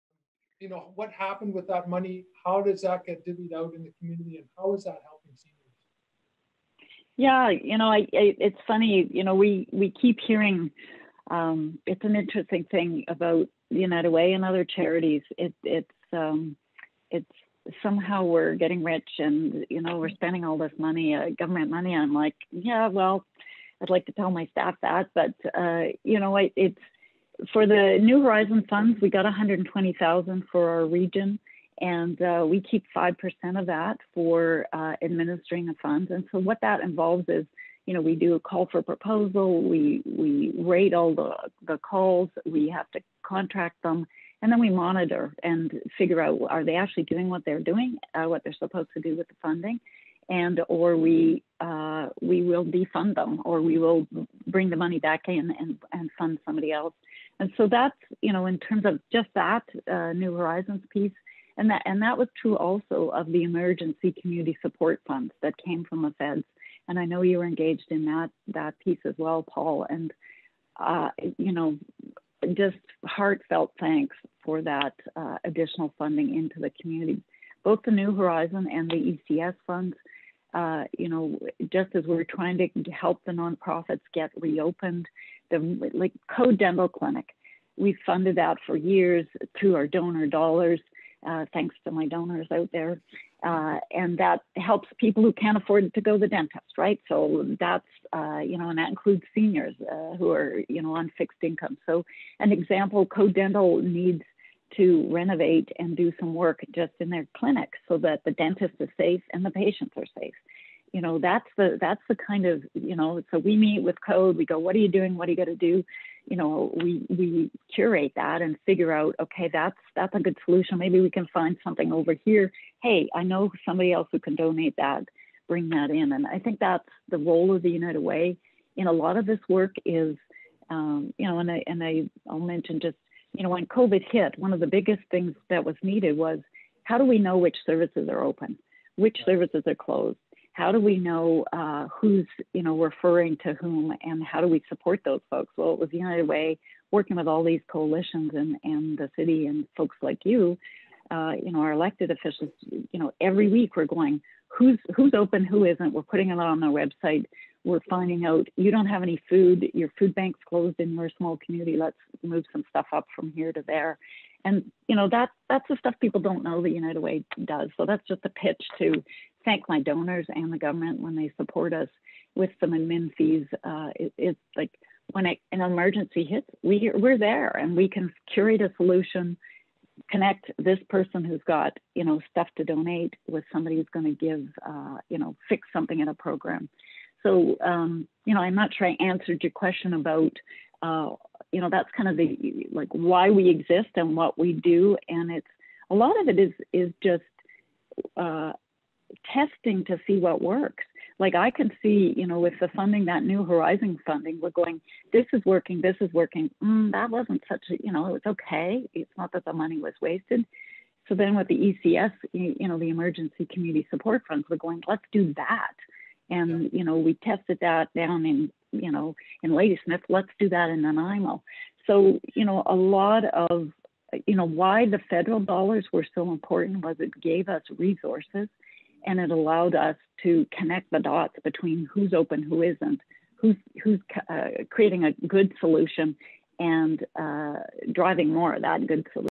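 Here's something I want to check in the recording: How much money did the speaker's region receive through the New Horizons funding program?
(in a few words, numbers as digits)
$120,000.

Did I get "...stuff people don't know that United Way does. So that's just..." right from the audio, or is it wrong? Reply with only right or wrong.
right.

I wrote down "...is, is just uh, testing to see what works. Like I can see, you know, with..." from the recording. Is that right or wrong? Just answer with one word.
right.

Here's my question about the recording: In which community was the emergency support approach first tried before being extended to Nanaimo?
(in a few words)
Ladysmith.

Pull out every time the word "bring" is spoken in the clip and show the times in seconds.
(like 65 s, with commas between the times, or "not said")
54 s, 125 s.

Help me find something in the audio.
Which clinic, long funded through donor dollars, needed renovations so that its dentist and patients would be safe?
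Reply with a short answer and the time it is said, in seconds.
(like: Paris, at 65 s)
Code Dental Clinic, at 86 s.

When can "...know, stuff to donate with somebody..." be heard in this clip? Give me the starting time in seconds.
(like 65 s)
182 s.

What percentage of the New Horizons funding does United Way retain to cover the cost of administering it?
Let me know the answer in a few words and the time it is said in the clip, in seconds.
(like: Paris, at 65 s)
5%, at 32 s.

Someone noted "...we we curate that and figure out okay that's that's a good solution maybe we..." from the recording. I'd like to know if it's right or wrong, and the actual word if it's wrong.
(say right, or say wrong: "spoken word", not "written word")
right.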